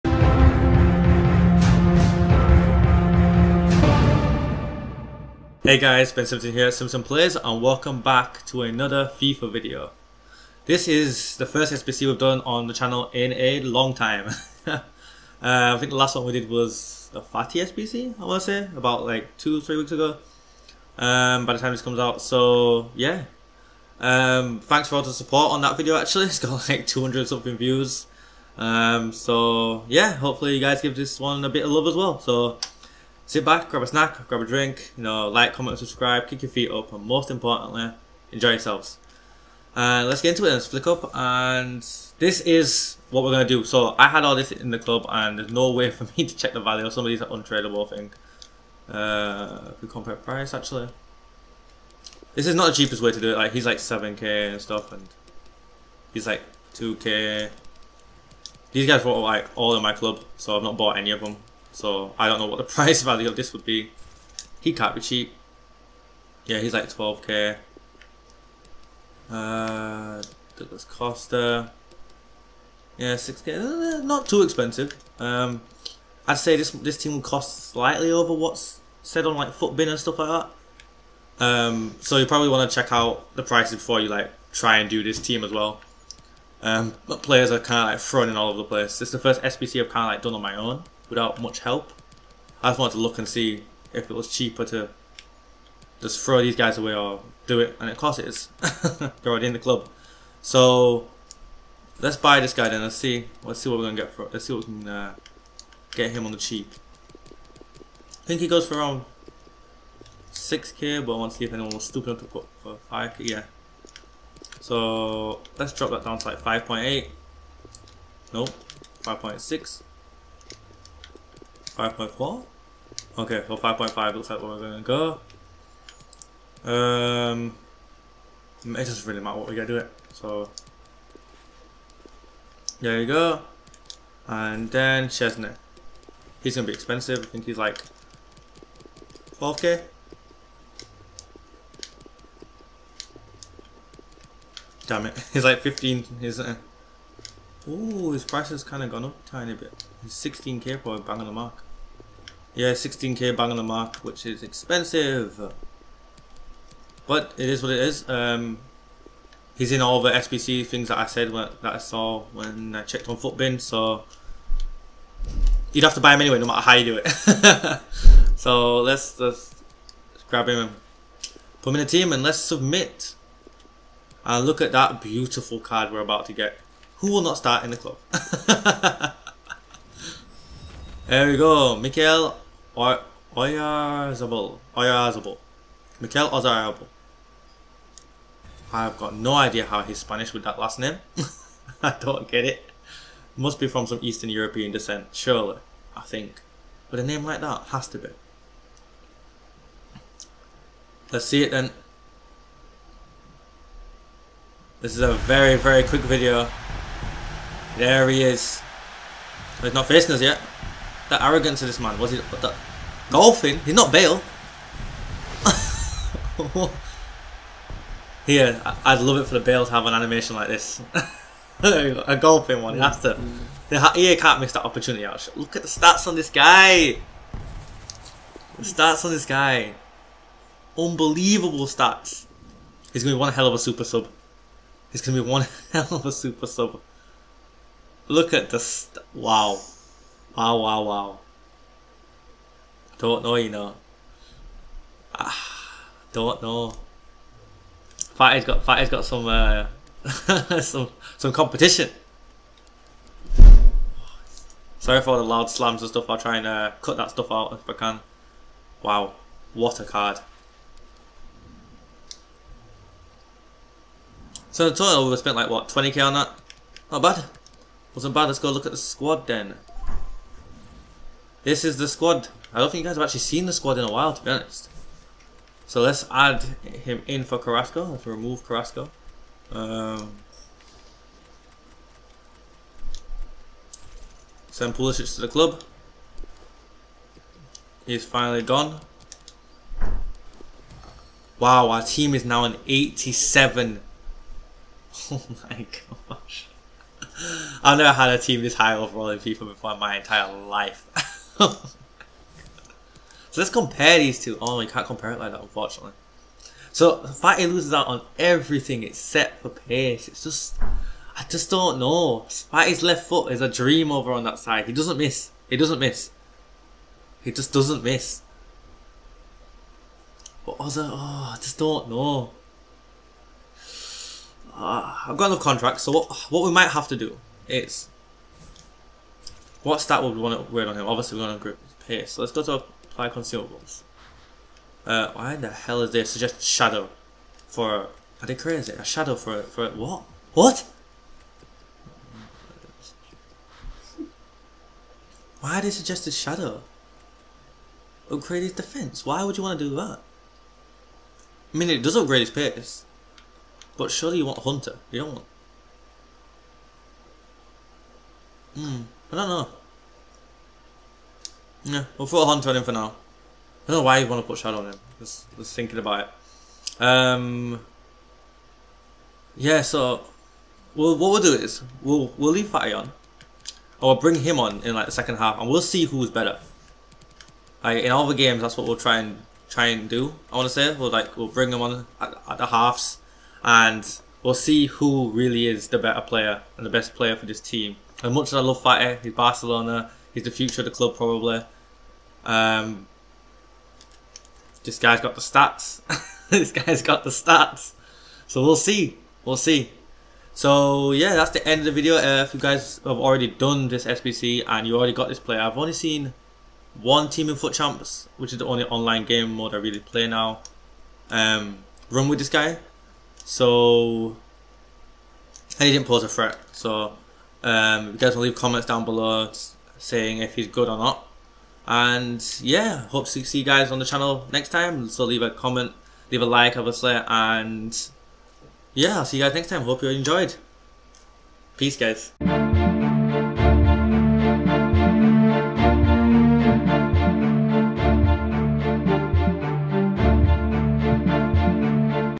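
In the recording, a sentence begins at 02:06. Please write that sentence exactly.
Um, it doesn't really matter what we get to it.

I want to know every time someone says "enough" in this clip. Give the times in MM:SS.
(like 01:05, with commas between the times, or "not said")
01:52, 05:25.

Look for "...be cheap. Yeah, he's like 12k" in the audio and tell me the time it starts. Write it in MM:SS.
01:04.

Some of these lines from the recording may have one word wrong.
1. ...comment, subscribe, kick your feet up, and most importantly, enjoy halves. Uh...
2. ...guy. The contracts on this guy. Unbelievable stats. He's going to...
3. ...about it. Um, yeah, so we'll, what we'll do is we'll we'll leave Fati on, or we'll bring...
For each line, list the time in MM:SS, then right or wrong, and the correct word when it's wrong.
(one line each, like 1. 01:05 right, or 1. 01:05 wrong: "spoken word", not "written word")
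1. 00:35 wrong: "yourselves", not "halves"
2. 03:46 wrong: "stats", not "contracts"
3. 06:05 right.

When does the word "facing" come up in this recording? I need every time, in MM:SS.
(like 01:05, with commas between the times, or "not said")
03:29.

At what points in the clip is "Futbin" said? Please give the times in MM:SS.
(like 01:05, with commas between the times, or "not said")
01:19, 02:43.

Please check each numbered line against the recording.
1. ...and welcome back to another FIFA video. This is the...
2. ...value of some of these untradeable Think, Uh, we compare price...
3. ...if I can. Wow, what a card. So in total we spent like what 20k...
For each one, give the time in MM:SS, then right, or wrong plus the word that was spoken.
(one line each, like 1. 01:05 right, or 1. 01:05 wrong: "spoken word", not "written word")
1. 00:07 right
2. 00:46 right
3. 04:17 right.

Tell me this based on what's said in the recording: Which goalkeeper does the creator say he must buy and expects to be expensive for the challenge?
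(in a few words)
Szczęsny.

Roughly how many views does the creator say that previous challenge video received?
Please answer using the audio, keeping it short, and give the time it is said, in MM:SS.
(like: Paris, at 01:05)
200 something, at 00:26.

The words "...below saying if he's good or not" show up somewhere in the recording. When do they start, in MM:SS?
06:58.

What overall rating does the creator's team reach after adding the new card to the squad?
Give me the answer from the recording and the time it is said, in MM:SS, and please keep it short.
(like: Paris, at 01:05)
87, at 04:52.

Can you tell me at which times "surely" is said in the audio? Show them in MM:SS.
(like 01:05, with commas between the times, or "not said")
03:15, 05:53.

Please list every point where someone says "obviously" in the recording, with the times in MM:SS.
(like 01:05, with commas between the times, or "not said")
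05:30, 07:06.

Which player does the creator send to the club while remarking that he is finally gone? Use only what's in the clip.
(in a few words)
Pulisic.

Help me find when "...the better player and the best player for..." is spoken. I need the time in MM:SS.
06:25.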